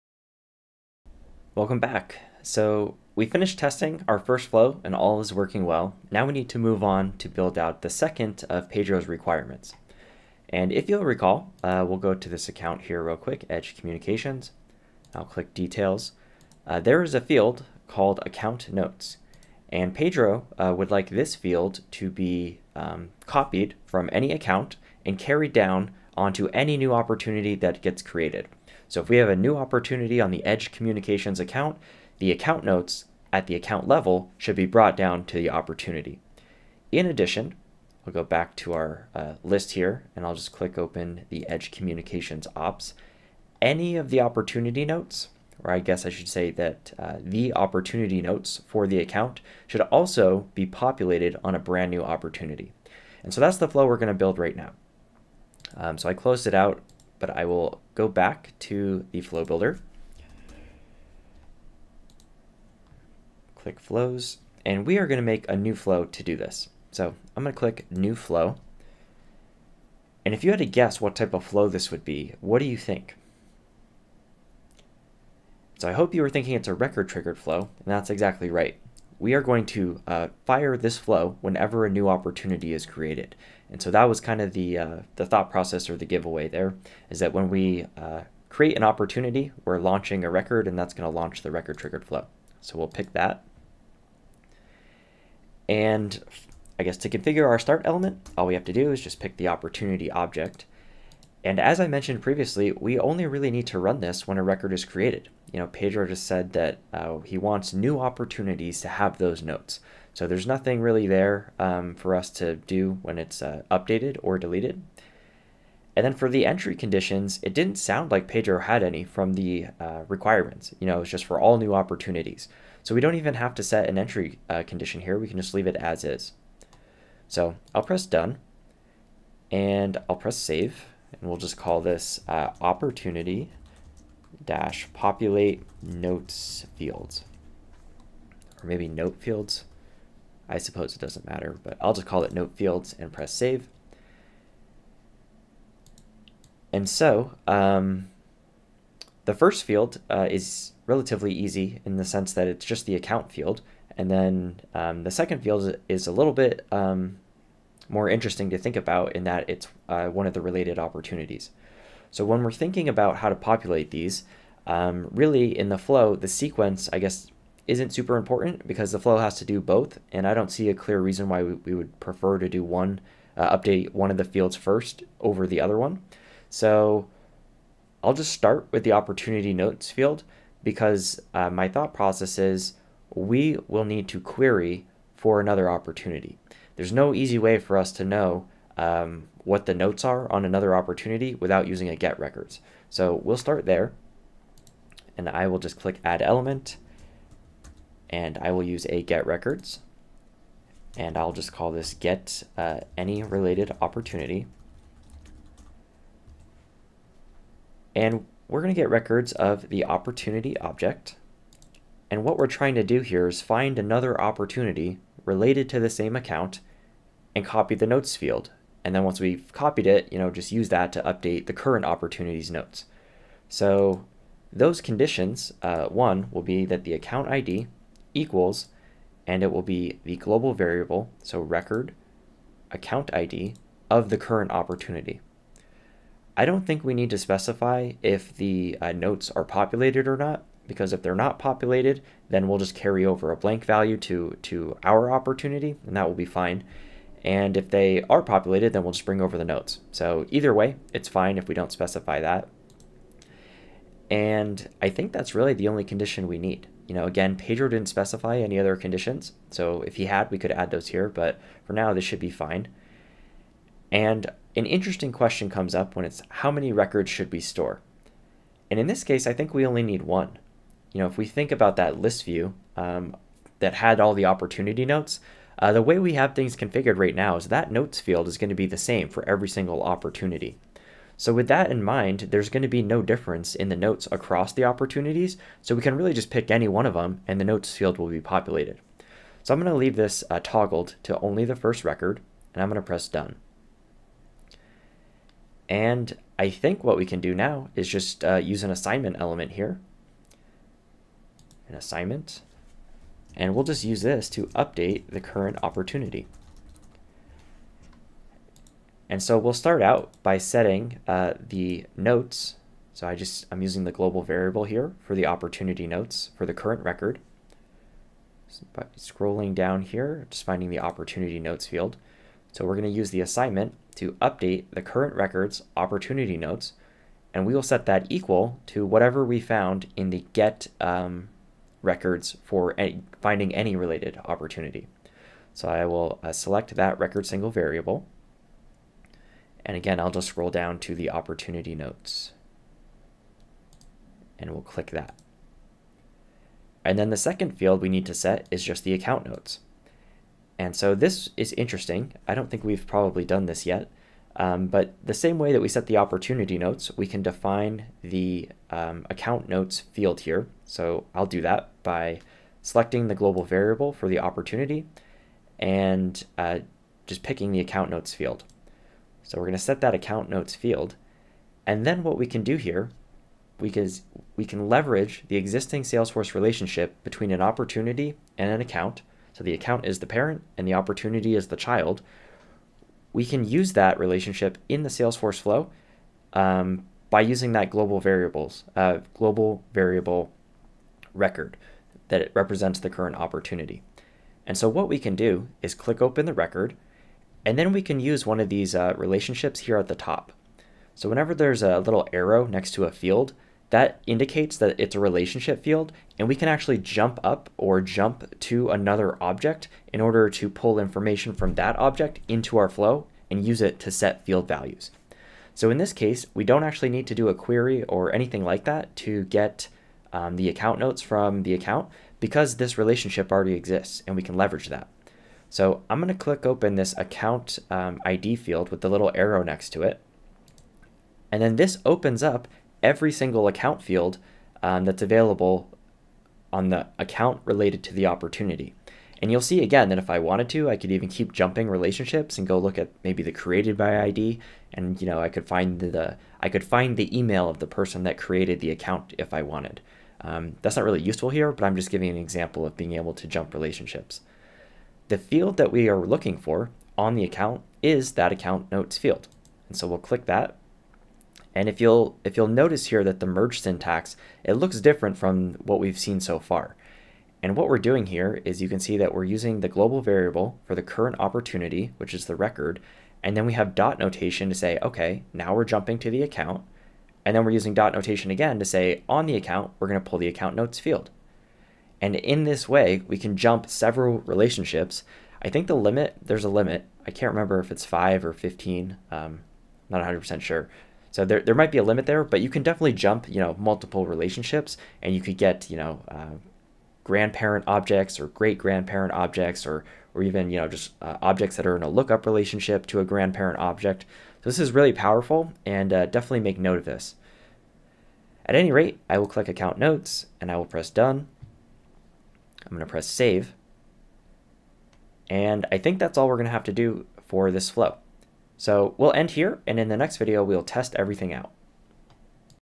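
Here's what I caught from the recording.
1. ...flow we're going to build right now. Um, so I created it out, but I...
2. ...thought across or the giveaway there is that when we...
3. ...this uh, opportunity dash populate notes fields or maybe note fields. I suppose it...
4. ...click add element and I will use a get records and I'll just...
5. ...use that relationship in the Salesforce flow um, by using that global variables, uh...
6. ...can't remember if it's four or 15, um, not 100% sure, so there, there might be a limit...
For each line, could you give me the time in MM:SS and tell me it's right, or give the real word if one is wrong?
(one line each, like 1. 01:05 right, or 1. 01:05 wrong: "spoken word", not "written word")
1. 00:53 wrong: "closed", not "created"
2. 01:25 wrong: "process", not "across"
3. 02:11 right
4. 03:15 right
5. 06:23 right
6. 08:07 wrong: "five", not "four".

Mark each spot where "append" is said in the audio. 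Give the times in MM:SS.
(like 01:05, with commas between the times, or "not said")
not said.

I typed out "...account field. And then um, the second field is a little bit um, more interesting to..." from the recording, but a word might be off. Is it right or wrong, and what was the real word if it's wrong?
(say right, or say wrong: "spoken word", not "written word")
right.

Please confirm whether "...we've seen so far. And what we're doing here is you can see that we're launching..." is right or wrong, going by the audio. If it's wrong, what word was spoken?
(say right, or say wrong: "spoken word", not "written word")
wrong: "using", not "launching".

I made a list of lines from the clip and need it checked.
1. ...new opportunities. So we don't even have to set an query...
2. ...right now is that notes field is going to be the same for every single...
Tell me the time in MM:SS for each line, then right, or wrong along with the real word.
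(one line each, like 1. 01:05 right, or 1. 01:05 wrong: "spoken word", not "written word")
1. 02:01 wrong: "entry", not "query"
2. 04:36 right.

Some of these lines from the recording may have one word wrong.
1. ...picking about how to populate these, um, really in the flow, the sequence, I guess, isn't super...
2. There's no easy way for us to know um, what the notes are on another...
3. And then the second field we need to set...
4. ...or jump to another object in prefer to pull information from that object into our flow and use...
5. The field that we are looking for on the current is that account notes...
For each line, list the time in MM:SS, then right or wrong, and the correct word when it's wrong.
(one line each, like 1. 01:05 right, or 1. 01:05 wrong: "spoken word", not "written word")
1. 02:42 wrong: "thinking", not "picking"
2. 03:06 right
3. 05:46 right
4. 06:47 wrong: "order", not "prefer"
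5. 07:35 wrong: "account", not "current".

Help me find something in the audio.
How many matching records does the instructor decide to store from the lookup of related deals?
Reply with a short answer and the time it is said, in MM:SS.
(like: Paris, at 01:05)
1, at 04:29.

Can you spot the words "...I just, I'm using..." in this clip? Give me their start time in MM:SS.
05:13.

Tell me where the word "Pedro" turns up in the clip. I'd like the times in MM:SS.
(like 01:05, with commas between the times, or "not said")
00:08, 00:19, 01:45, 01:58, 04:17.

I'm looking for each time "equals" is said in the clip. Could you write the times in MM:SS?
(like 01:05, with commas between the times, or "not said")
03:48, 05:28.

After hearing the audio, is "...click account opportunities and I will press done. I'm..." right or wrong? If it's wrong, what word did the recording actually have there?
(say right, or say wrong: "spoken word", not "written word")
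wrong: "notes", not "opportunities".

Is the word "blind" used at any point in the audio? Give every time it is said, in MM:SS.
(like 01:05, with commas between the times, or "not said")
not said.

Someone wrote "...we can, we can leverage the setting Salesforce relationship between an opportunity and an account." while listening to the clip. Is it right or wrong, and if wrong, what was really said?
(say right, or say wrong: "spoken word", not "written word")
wrong: "existing", not "setting".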